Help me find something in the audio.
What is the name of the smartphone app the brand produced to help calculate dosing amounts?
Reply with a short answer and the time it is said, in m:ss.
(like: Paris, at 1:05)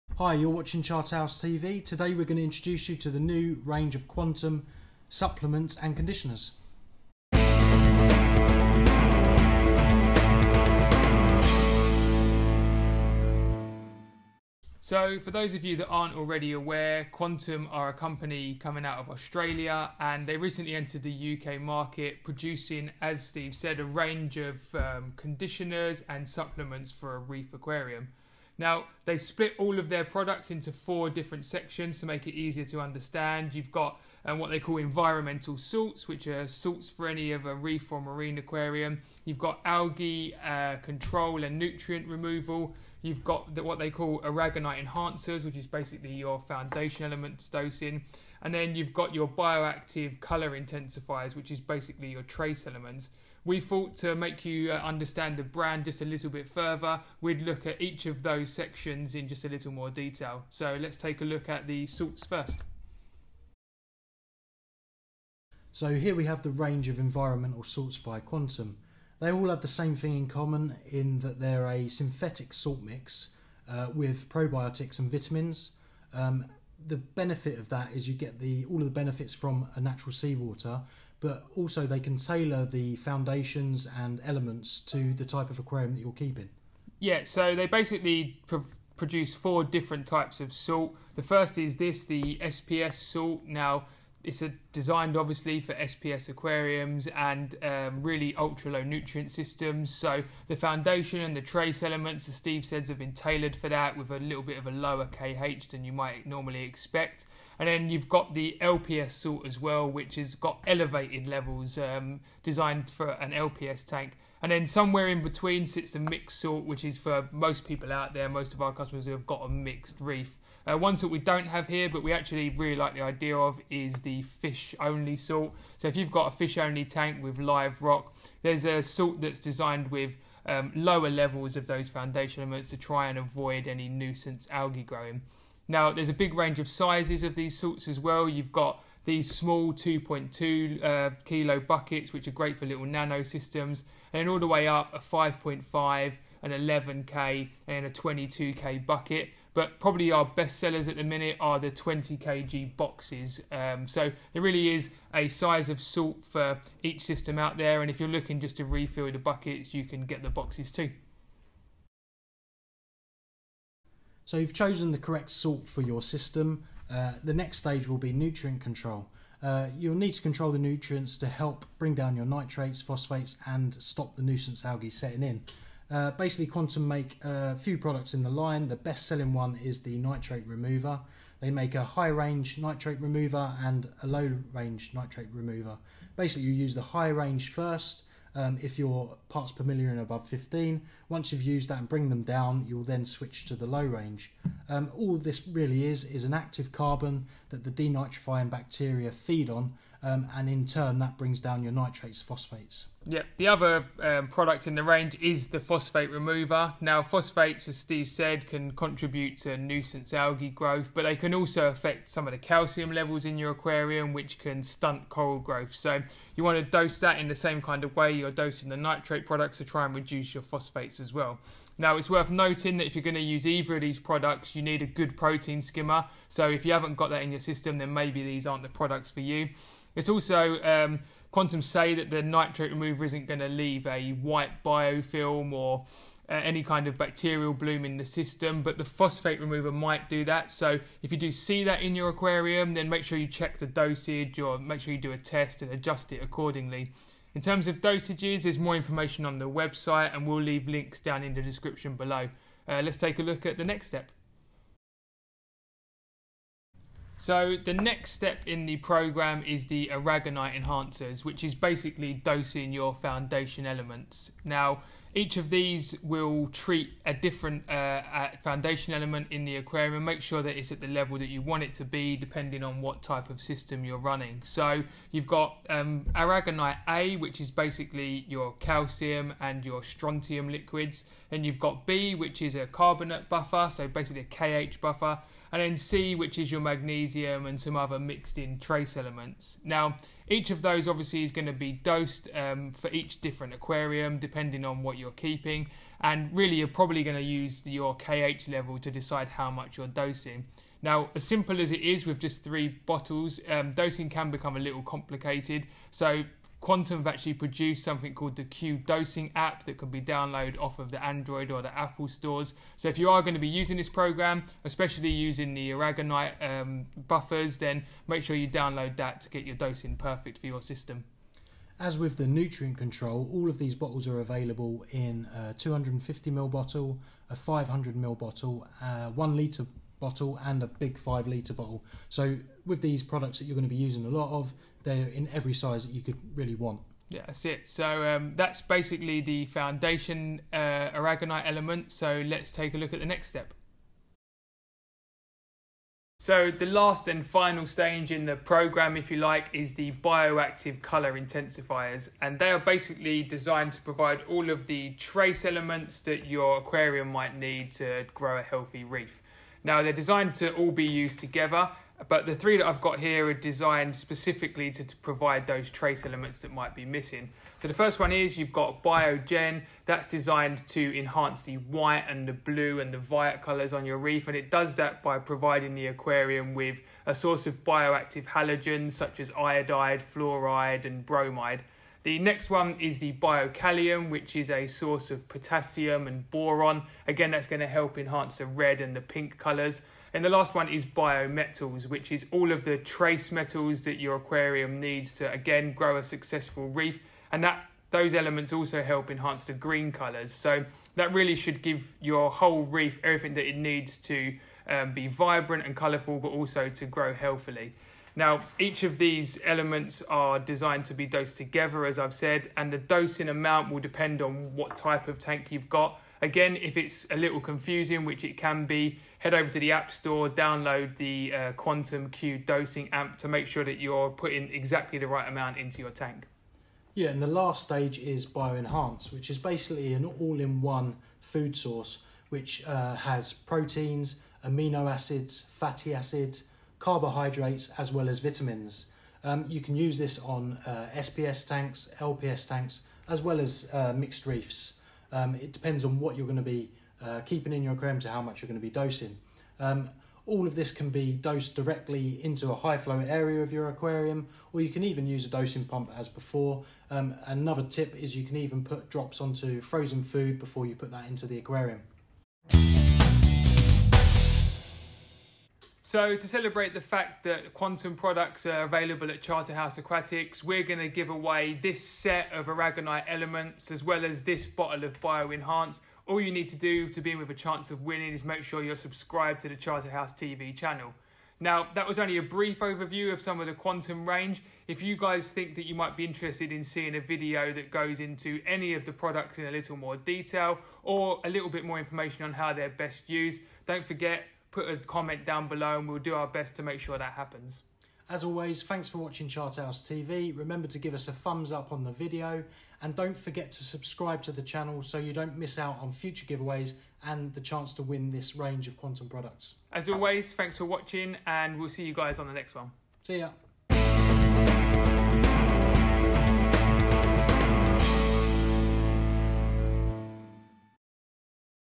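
Q Dosing app, at 5:08.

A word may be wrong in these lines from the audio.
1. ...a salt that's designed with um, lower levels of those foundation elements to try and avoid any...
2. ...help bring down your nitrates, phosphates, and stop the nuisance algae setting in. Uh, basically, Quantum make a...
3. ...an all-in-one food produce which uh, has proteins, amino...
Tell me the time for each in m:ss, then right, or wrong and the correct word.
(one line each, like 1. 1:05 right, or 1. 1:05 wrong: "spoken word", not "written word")
1. 2:08 right
2. 2:51 right
3. 7:09 wrong: "source", not "produce".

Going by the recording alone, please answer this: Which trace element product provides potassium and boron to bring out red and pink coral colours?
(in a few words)
Biokalium.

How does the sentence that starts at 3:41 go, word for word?
Now, it's worth noting that if you're going to use either of these products, you need a good protein skimmer.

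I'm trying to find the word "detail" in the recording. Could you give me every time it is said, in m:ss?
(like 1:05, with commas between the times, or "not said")
0:59, 8:09.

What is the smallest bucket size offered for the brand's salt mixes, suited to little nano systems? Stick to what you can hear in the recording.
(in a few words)
2.2 kilo.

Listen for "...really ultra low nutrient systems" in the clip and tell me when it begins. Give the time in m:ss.
1:38.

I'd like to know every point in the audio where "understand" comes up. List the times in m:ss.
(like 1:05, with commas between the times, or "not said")
0:32, 0:54.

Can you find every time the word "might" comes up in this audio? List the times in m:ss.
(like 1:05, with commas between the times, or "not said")
1:45, 3:59, 5:57, 6:06, 8:05.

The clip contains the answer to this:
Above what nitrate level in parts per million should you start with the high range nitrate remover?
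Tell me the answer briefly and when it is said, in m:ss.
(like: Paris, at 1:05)
15, at 3:10.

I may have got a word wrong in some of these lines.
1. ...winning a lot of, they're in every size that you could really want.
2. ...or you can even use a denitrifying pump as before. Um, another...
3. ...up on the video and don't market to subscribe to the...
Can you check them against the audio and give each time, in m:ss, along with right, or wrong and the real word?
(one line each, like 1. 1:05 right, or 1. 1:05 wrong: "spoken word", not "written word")
1. 5:33 wrong: "using", not "winning"
2. 7:34 wrong: "dosing", not "denitrifying"
3. 8:21 wrong: "forget", not "market".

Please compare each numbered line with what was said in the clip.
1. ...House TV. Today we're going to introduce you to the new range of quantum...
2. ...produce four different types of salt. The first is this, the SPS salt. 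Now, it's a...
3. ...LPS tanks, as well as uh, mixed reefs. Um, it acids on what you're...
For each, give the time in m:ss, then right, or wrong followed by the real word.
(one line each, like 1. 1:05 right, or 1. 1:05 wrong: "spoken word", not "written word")
1. 0:00 right
2. 1:28 right
3. 7:21 wrong: "depends", not "acids".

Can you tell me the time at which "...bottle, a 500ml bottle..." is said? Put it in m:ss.
5:26.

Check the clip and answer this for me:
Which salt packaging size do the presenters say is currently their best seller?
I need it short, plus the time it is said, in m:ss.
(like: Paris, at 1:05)
20 kg boxes, at 2:31.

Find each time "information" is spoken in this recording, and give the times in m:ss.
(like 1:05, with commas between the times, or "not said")
4:08, 8:11.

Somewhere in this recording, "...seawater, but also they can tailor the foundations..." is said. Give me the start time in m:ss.
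1:20.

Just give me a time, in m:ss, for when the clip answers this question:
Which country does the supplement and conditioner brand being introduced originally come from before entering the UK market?
0:19.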